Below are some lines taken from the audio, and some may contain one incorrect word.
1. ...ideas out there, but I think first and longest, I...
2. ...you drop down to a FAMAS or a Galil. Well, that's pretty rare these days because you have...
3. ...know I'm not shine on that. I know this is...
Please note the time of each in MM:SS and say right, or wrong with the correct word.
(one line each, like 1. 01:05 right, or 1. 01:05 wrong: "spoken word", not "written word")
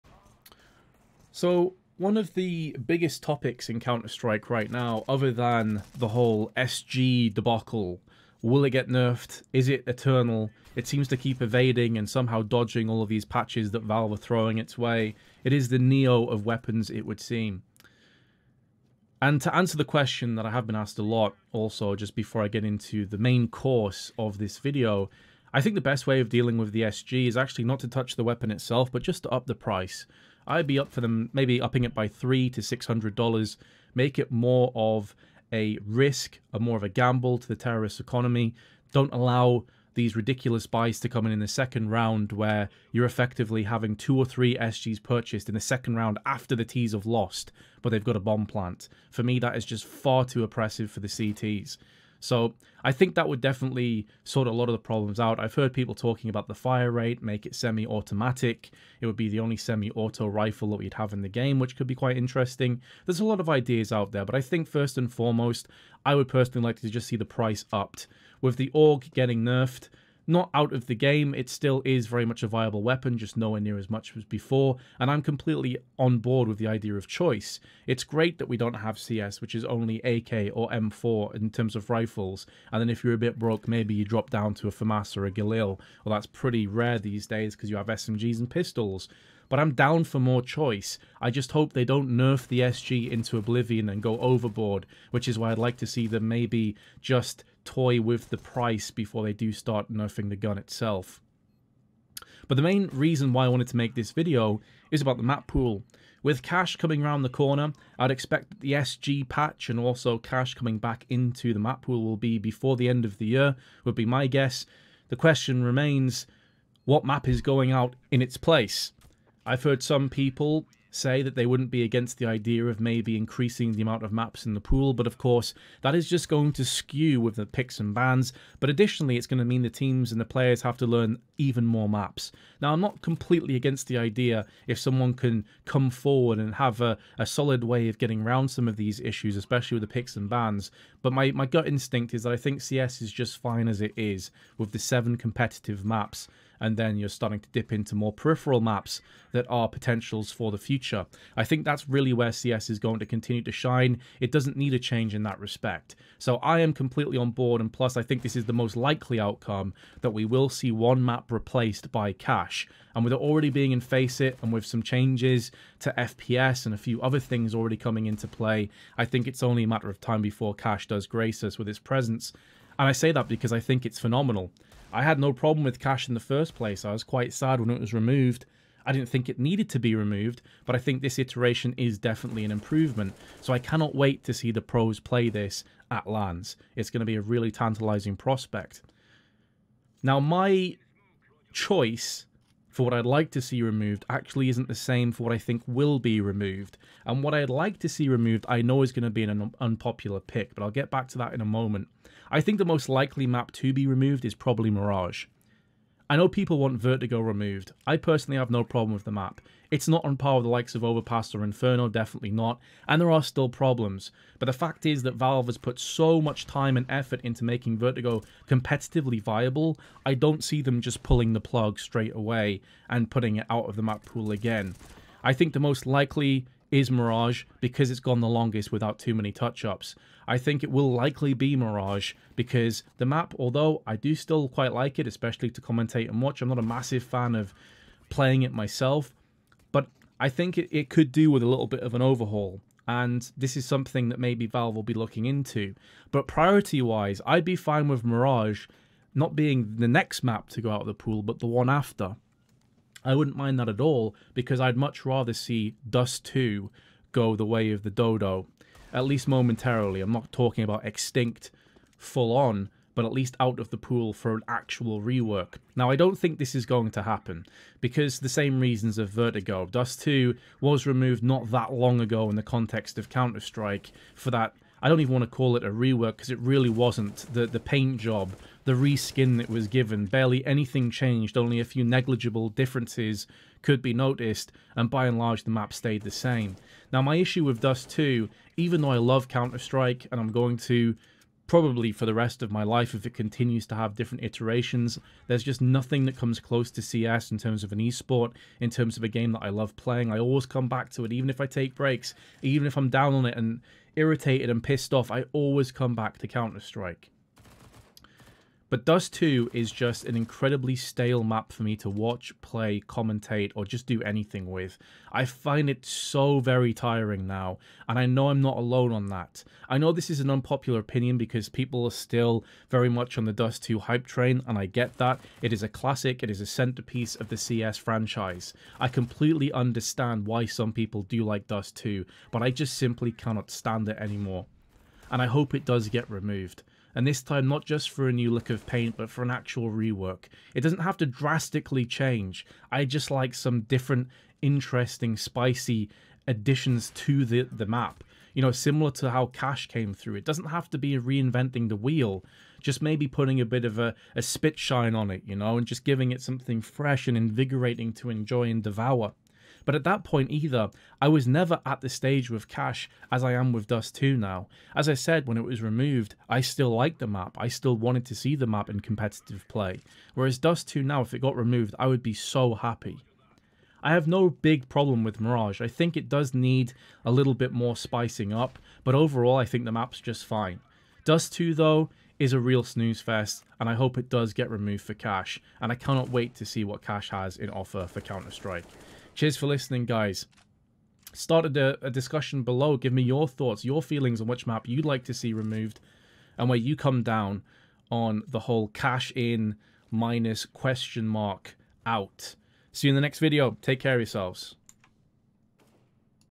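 1. 01:03 wrong: "foremost", not "longest"
2. 01:23 right
3. 05:18 wrong: "alone", not "shine".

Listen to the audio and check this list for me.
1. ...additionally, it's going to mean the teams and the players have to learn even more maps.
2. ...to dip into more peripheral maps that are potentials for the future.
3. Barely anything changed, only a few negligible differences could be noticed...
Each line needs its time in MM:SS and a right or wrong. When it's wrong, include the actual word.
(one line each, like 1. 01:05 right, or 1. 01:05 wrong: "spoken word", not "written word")
1. 02:08 right
2. 02:27 right
3. 04:40 right.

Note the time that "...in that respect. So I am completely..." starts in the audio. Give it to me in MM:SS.
02:35.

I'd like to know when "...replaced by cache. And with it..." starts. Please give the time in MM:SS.
02:41.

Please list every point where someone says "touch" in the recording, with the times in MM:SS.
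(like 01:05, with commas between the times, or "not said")
00:27, 03:49.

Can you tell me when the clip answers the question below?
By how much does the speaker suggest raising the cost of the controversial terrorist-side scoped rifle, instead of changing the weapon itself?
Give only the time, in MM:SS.
00:32.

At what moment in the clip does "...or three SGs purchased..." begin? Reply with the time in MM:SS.
00:44.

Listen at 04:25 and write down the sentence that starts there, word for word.
Now, I don't think this is going to happen because the same reasons of Vertigo.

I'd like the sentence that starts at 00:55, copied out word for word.
I've heard people talking about the fire rate, make it semi-automatic.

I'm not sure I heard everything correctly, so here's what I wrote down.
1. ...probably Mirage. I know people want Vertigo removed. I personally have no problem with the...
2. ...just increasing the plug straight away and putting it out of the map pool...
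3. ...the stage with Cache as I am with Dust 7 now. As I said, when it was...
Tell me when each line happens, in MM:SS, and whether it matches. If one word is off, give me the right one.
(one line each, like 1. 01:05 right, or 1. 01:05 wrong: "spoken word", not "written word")
1. 03:24 right
2. 03:40 wrong: "pulling", not "increasing"
3. 06:01 wrong: "2", not "7".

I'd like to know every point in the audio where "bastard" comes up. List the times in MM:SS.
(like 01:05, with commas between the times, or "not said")
not said.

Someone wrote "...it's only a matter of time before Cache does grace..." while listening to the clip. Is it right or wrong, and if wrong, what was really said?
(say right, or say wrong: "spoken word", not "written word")
right.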